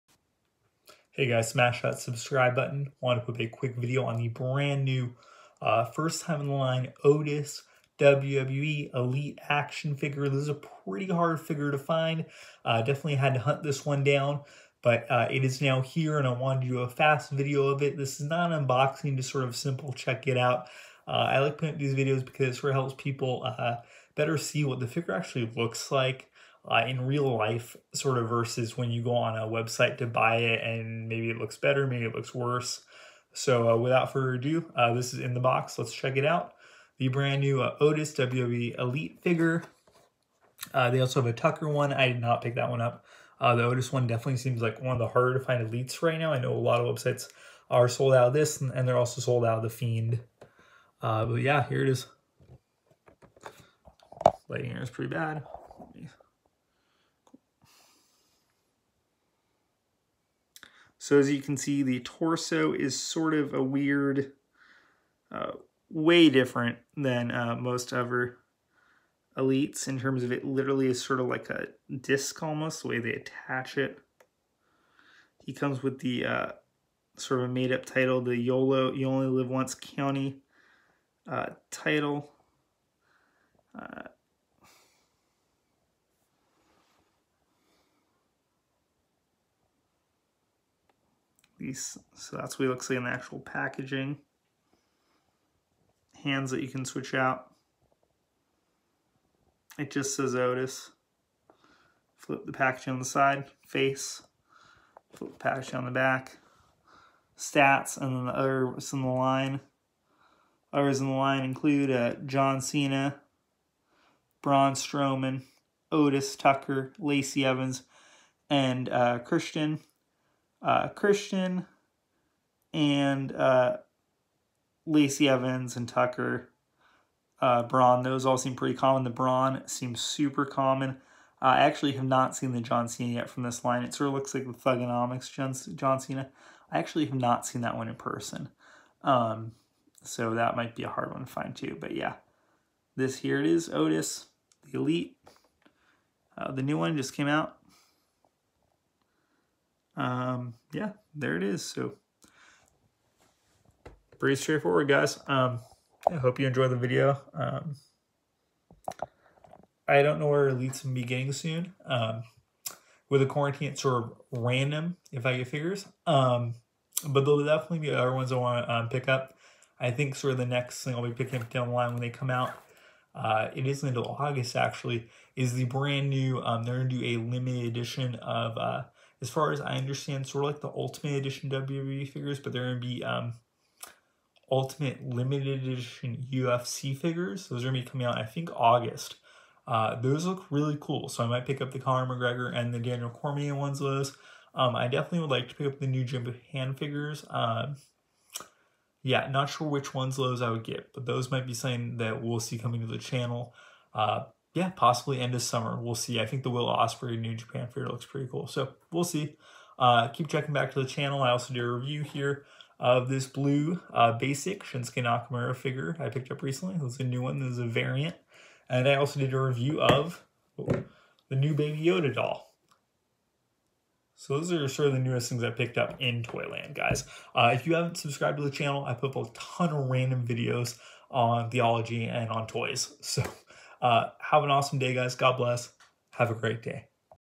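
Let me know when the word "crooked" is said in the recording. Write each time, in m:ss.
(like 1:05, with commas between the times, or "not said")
not said.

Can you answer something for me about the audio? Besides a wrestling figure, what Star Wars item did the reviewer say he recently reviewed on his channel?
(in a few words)
Baby Yoda doll.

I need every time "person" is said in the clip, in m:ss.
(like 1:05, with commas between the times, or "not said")
2:17.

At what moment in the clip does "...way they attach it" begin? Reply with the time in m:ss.
1:12.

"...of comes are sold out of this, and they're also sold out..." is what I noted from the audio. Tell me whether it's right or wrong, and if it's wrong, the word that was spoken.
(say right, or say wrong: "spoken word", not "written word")
wrong: "websites", not "comes".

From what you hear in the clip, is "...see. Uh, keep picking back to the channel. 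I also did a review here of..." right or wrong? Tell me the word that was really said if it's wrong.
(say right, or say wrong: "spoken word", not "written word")
wrong: "checking", not "picking".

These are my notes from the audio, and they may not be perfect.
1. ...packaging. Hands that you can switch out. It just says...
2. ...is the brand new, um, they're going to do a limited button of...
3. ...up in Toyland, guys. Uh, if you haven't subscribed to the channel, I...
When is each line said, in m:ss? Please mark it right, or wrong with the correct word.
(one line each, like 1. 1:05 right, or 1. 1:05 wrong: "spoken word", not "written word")
1. 1:33 right
2. 2:55 wrong: "edition", not "button"
3. 3:45 right.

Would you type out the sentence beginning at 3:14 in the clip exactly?
Um, I definitely would like to pick up the new Jim hand figures.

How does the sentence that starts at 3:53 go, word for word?
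So uh, have an awesome day, guys.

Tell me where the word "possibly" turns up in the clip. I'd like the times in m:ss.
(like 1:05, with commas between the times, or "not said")
3:24.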